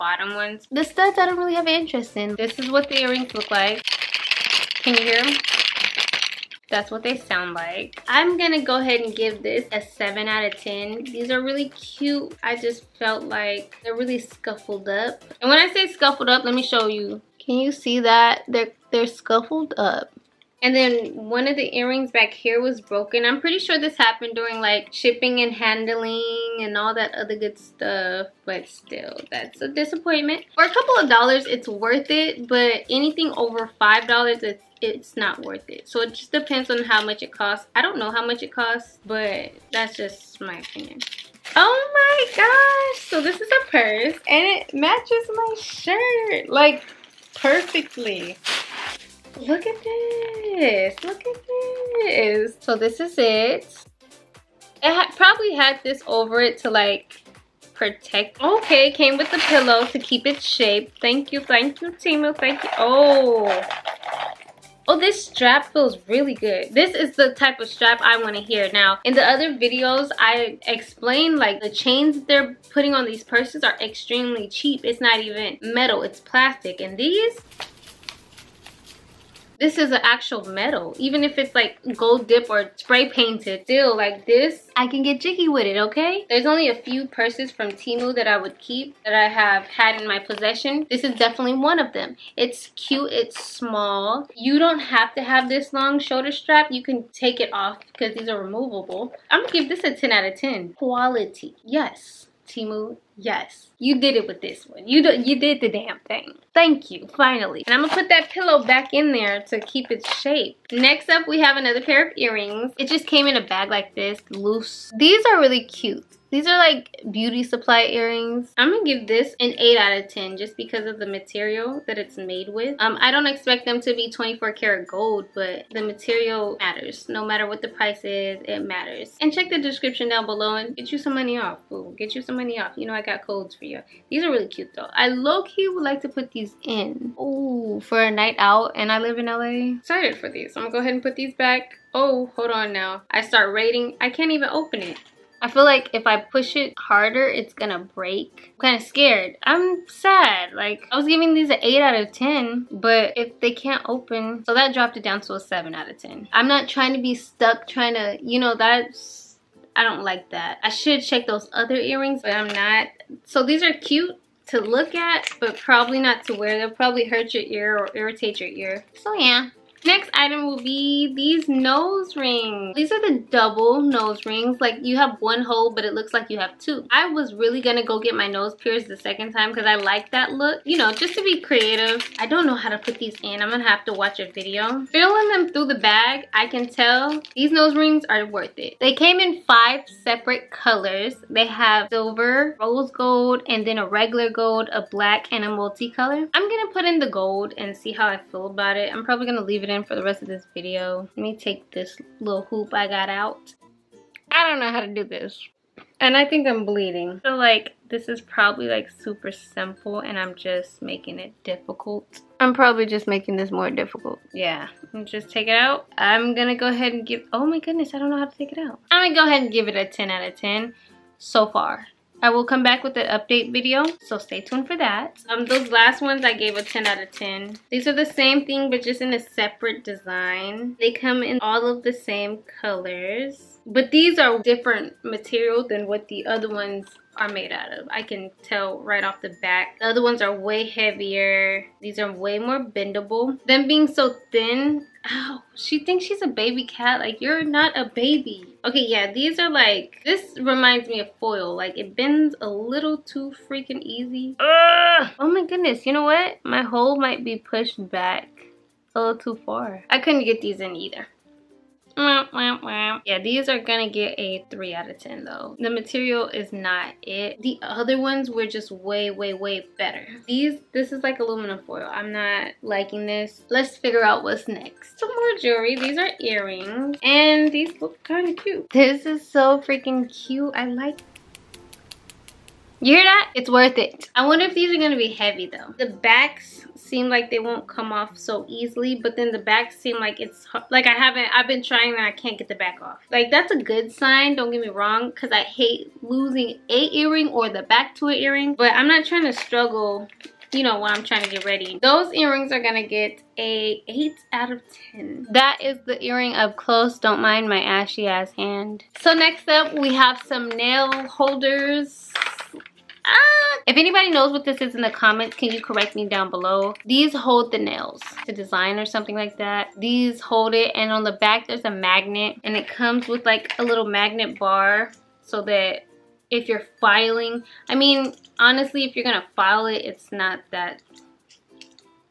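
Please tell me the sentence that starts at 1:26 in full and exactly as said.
There's only a few purses from Temu that I would keep that I have had in my possession.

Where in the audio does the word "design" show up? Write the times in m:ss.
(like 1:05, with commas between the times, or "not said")
3:49, 5:18.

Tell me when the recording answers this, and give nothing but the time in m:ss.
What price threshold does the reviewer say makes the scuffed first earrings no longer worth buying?
0:33.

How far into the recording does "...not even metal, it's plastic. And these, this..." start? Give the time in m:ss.
1:14.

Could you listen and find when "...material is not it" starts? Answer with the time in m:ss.
4:25.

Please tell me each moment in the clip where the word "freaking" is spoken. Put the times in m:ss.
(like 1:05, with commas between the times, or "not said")
4:13, 4:39.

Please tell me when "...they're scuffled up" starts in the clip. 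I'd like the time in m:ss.
0:18.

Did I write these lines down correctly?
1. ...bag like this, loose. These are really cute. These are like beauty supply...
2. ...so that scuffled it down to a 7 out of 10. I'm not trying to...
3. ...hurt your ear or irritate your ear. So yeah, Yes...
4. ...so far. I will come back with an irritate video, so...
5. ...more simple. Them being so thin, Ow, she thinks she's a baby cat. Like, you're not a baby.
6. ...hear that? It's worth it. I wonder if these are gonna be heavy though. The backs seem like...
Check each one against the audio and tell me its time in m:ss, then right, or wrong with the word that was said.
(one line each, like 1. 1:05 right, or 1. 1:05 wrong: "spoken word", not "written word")
1. 1:53 right
2. 2:34 wrong: "dropped", not "scuffled"
3. 2:47 wrong: "Next", not "Yes"
4. 3:41 wrong: "update", not "irritate"
5. 4:02 wrong: "bendable", not "simple"
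6. 4:42 right.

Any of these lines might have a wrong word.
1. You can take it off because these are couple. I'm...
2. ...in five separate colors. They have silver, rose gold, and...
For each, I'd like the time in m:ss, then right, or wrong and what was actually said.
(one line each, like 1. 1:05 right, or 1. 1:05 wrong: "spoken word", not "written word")
1. 1:36 wrong: "removable", not "couple"
2. 3:09 right.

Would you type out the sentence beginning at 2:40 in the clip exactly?
I should check those other earrings, but I'm not.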